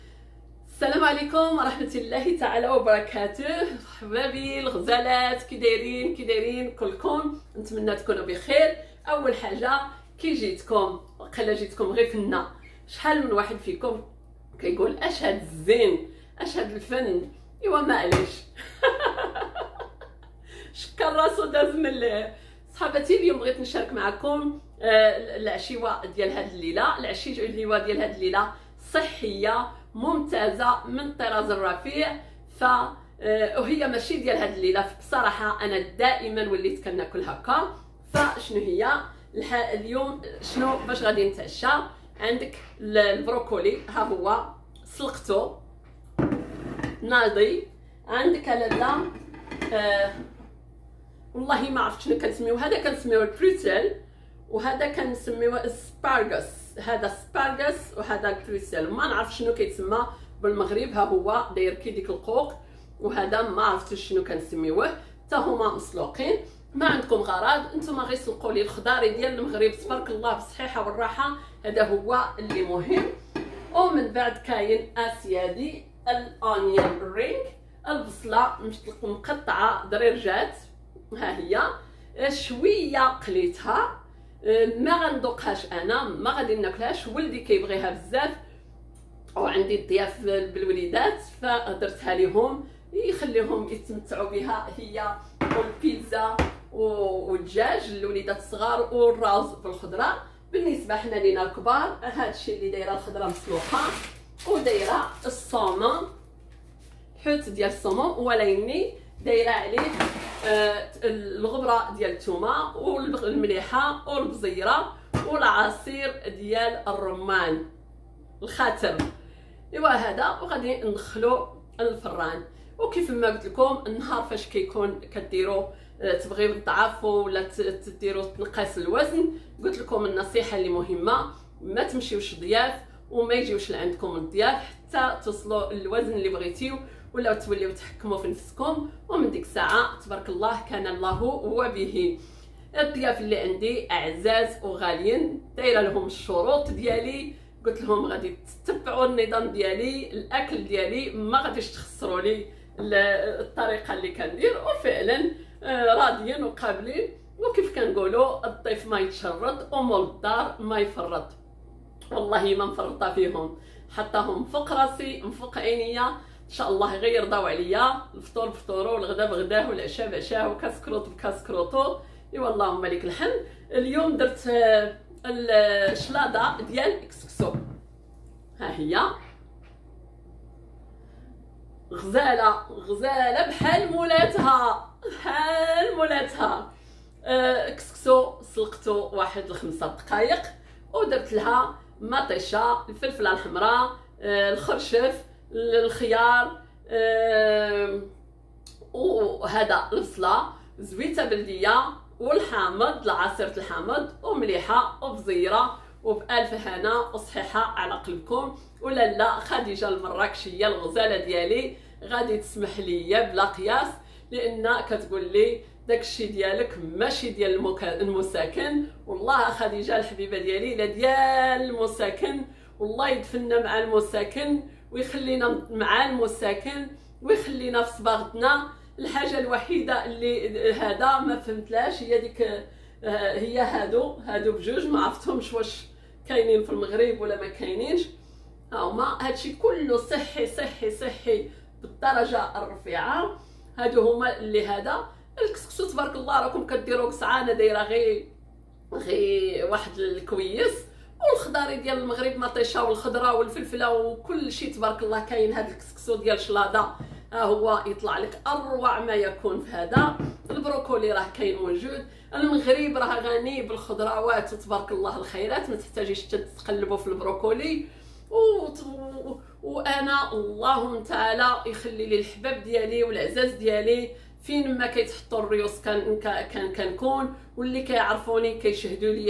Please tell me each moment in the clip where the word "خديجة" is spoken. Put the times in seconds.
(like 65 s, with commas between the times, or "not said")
209 s, 219 s.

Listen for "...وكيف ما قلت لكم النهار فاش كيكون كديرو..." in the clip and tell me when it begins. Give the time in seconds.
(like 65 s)
122 s.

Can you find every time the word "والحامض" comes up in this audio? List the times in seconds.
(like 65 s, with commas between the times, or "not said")
202 s.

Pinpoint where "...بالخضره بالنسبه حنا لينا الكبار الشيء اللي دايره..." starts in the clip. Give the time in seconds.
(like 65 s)
99 s.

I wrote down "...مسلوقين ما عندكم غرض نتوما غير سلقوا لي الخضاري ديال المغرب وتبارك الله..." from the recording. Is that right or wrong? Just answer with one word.
wrong.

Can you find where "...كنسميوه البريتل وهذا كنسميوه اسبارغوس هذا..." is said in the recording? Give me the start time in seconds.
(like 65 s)
52 s.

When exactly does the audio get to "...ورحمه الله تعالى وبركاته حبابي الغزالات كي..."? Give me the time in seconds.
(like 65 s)
1 s.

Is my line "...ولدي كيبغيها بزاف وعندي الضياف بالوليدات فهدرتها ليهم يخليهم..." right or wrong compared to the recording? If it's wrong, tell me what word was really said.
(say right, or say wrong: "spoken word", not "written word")
right.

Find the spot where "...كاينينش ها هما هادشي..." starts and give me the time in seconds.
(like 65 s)
237 s.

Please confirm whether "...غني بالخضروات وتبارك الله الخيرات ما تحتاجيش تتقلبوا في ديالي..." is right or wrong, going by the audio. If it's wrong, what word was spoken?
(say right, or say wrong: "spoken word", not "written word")
wrong: "البروكولي", not "ديالي".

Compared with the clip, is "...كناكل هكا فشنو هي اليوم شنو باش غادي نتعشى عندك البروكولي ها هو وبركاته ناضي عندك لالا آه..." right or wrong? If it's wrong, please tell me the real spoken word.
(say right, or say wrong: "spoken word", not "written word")
wrong: "سلقته", not "وبركاته".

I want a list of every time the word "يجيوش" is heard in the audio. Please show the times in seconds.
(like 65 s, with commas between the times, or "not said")
133 s.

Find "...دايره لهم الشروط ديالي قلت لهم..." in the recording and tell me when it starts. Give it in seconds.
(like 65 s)
145 s.